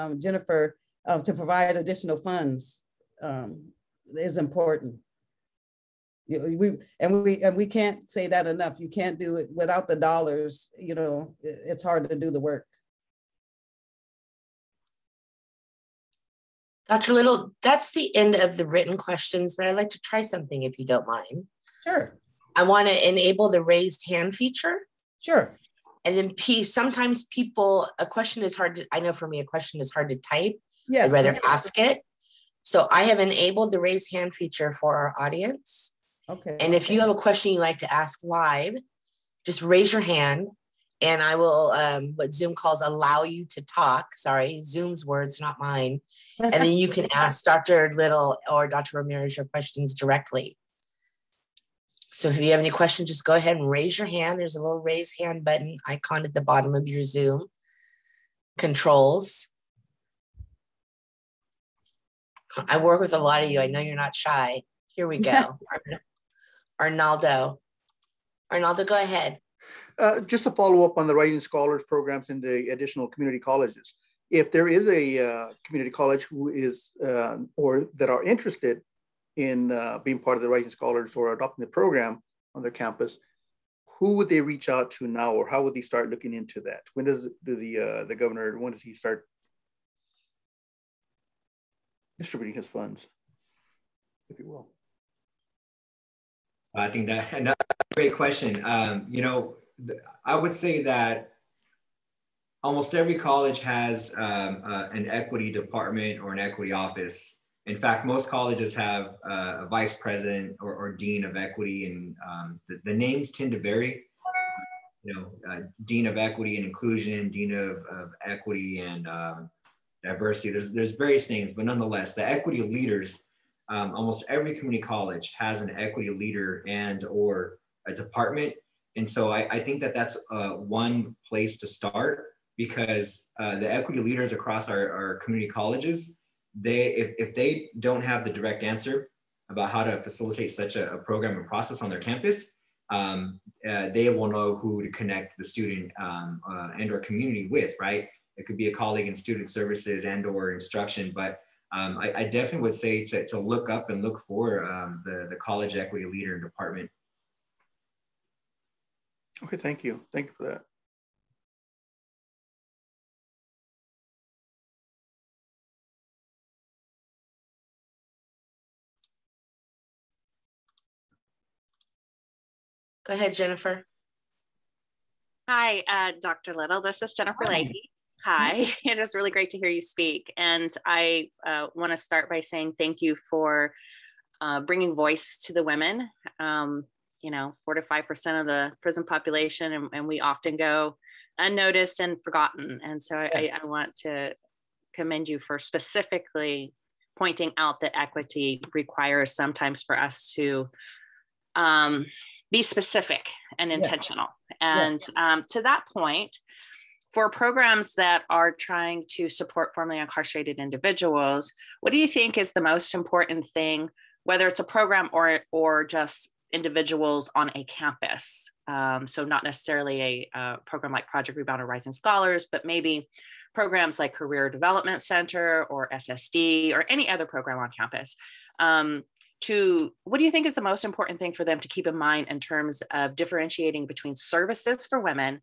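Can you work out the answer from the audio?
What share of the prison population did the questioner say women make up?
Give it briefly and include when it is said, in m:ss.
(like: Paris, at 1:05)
4 to 5 percent, at 3:07.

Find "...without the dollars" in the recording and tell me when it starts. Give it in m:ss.
0:09.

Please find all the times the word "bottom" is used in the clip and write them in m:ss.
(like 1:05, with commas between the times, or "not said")
0:56.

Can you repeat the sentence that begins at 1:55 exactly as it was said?
You know, uh, dean of equity and inclusion, dean of, of equity and um, diversity.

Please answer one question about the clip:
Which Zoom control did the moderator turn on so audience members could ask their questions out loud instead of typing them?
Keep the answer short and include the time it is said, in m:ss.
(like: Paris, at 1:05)
raise hand feature, at 0:33.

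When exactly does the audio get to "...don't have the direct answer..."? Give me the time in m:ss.
2:17.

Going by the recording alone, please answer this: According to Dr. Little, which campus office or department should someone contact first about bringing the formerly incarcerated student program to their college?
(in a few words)
equity department.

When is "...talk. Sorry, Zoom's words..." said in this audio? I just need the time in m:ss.
0:43.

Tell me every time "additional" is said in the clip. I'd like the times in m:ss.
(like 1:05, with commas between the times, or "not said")
0:01, 1:12.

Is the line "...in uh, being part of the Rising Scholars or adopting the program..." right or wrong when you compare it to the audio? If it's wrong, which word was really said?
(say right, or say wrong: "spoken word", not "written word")
right.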